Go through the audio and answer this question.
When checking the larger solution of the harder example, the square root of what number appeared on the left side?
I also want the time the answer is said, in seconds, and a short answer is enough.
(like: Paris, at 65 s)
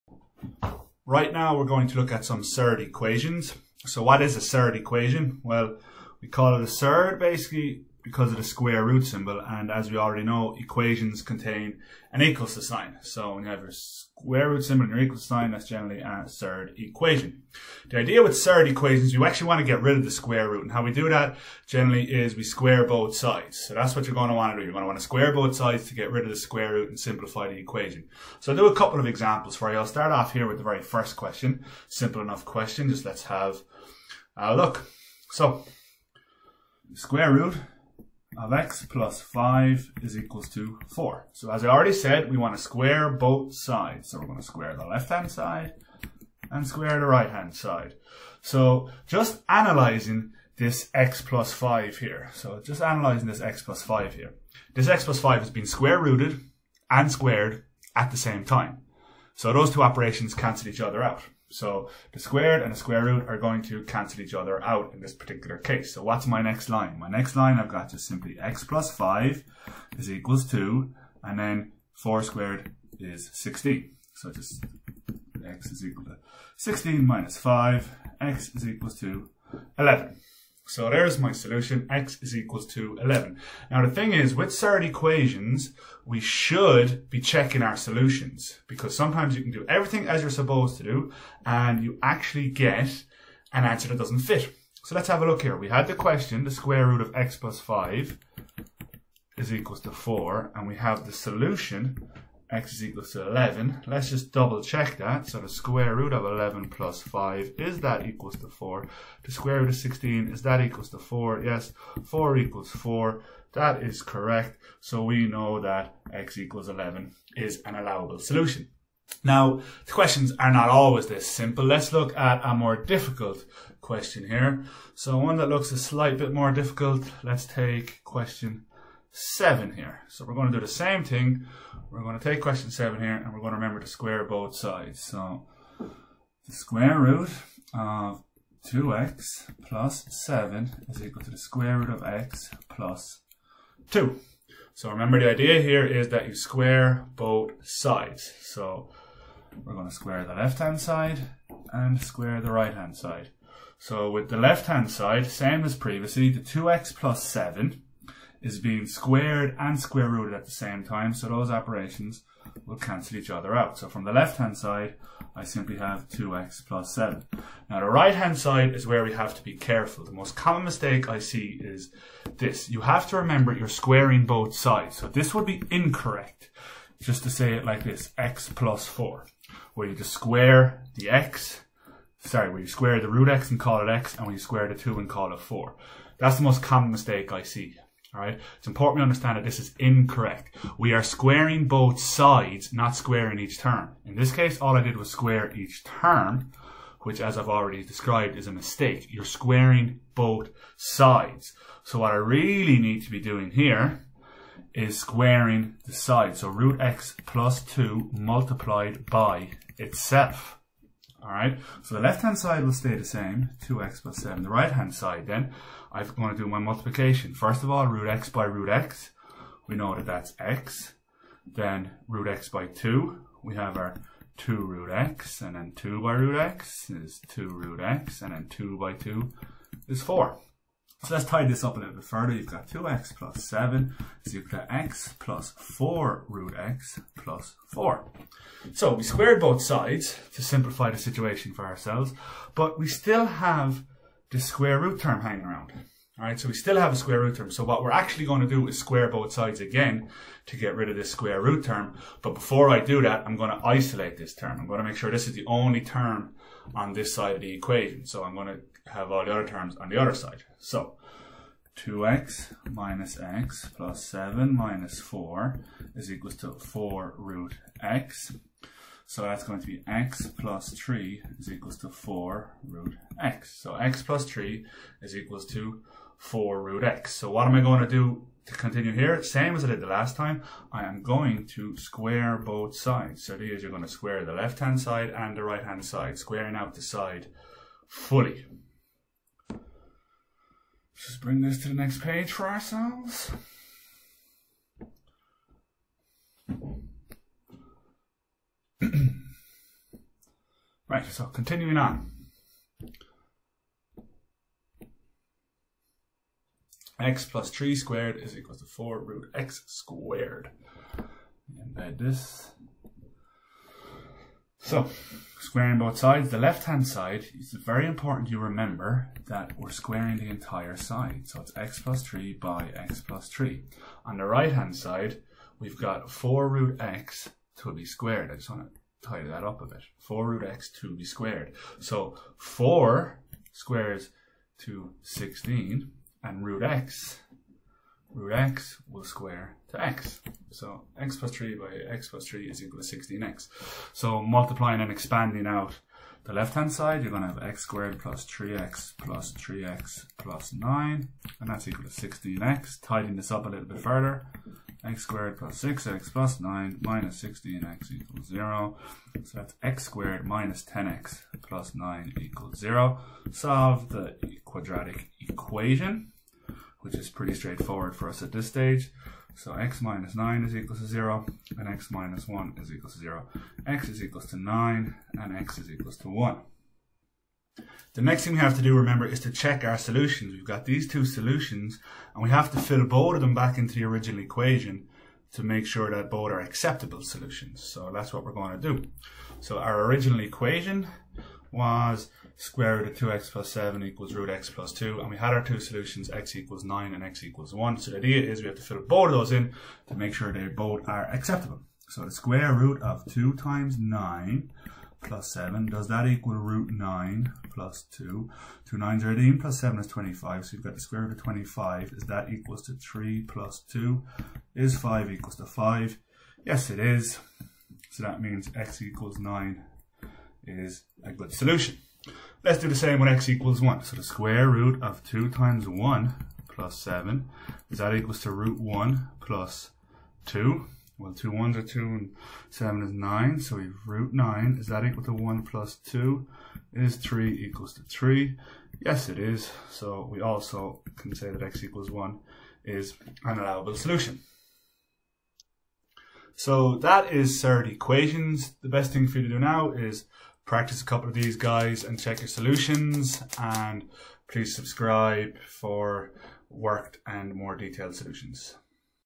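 25, at 410 s.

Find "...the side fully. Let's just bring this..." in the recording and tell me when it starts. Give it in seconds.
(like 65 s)
286 s.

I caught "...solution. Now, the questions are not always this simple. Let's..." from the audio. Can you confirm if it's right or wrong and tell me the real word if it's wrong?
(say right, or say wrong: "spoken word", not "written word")
right.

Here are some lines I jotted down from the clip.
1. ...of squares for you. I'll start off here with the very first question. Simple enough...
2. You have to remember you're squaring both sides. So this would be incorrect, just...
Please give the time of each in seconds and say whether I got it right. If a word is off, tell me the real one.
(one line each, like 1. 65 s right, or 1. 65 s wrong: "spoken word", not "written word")
1. 28 s wrong: "examples", not "squares"
2. 172 s right.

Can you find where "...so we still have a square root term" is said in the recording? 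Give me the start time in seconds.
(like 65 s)
246 s.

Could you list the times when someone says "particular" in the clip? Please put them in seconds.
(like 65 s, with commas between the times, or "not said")
65 s.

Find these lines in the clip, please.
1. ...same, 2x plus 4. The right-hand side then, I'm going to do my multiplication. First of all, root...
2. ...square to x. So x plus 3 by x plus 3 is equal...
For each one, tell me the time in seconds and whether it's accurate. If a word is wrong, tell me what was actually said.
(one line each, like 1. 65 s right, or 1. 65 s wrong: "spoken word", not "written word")
1. 213 s wrong: "7", not "4"
2. 339 s right.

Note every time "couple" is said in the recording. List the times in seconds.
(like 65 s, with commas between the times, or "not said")
28 s, 450 s.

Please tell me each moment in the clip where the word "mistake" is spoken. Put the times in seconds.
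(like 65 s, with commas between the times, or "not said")
170 s, 186 s, 198 s.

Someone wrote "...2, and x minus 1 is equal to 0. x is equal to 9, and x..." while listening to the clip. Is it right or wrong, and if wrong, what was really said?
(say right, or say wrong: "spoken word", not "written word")
wrong: "0", not "2".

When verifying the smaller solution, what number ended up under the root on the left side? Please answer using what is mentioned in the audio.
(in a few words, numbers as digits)
9.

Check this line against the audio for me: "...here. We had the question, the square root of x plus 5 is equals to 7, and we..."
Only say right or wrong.
wrong.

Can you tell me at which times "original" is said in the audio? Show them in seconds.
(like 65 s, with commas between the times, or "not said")
383 s, 389 s.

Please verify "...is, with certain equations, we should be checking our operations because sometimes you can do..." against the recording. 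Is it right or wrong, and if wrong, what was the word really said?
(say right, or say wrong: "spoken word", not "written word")
wrong: "solutions", not "operations".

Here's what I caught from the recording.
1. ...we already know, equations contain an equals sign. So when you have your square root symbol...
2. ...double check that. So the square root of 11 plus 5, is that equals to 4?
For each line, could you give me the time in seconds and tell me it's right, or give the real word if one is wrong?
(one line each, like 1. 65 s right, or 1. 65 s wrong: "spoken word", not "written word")
1. 9 s right
2. 104 s right.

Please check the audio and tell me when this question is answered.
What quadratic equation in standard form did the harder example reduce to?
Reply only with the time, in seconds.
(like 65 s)
359 s.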